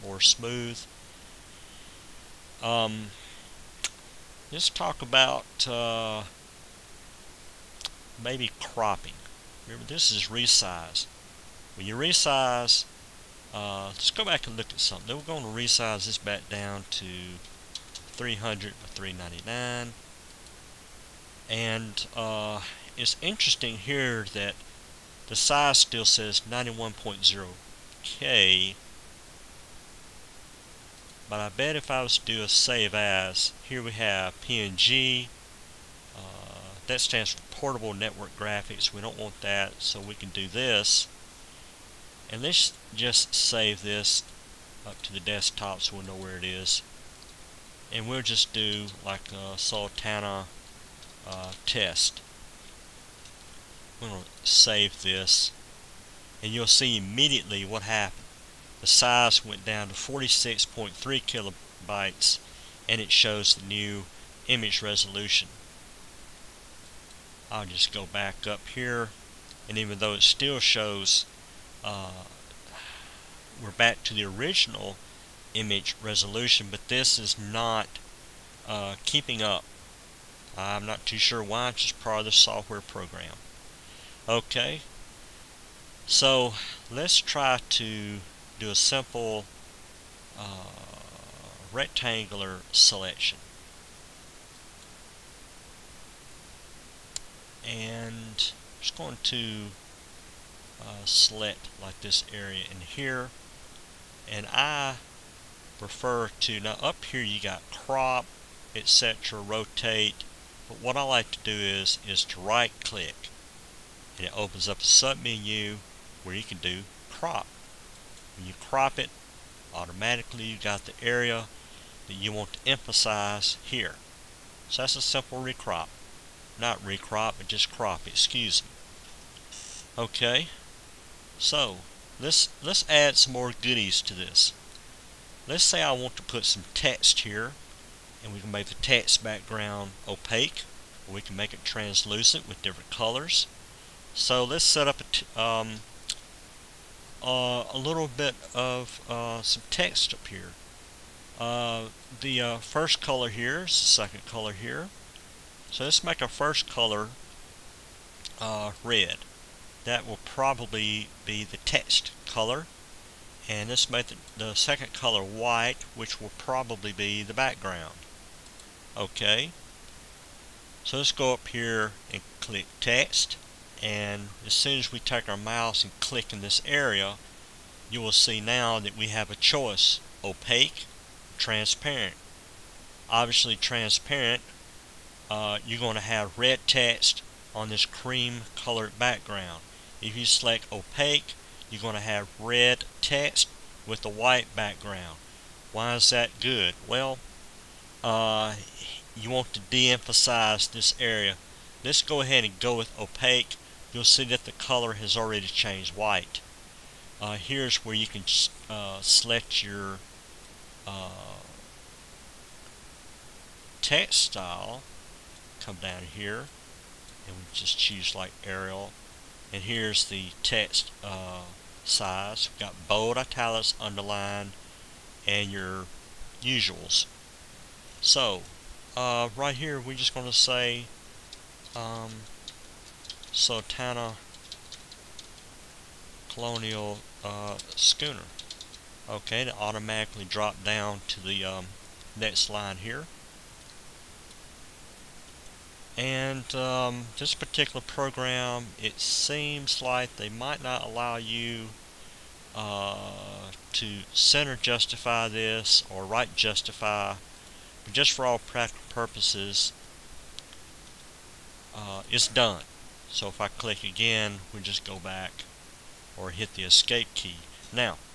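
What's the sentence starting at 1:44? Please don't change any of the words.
And I prefer to, now up here you got crop, etc., rotate.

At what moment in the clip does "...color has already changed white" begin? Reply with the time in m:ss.
3:24.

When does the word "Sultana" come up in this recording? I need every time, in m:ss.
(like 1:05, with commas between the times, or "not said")
0:49, 3:53.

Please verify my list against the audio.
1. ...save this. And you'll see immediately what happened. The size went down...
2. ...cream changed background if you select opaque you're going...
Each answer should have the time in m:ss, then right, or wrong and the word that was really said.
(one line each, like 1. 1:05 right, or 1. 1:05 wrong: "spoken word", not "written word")
1. 0:54 right
2. 3:07 wrong: "colored", not "changed".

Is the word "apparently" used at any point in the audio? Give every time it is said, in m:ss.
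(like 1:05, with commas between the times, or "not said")
not said.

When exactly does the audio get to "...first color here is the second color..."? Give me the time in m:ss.
2:32.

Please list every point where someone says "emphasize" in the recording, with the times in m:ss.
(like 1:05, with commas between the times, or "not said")
2:02, 3:19.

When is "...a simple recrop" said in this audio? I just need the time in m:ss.
2:04.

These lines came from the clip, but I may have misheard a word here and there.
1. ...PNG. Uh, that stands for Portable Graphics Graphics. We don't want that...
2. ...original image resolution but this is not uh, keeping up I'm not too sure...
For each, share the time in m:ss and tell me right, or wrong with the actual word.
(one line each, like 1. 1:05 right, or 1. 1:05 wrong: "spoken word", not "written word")
1. 0:34 wrong: "Network", not "Graphics"
2. 1:14 right.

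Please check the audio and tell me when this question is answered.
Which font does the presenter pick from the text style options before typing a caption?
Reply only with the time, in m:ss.
3:38.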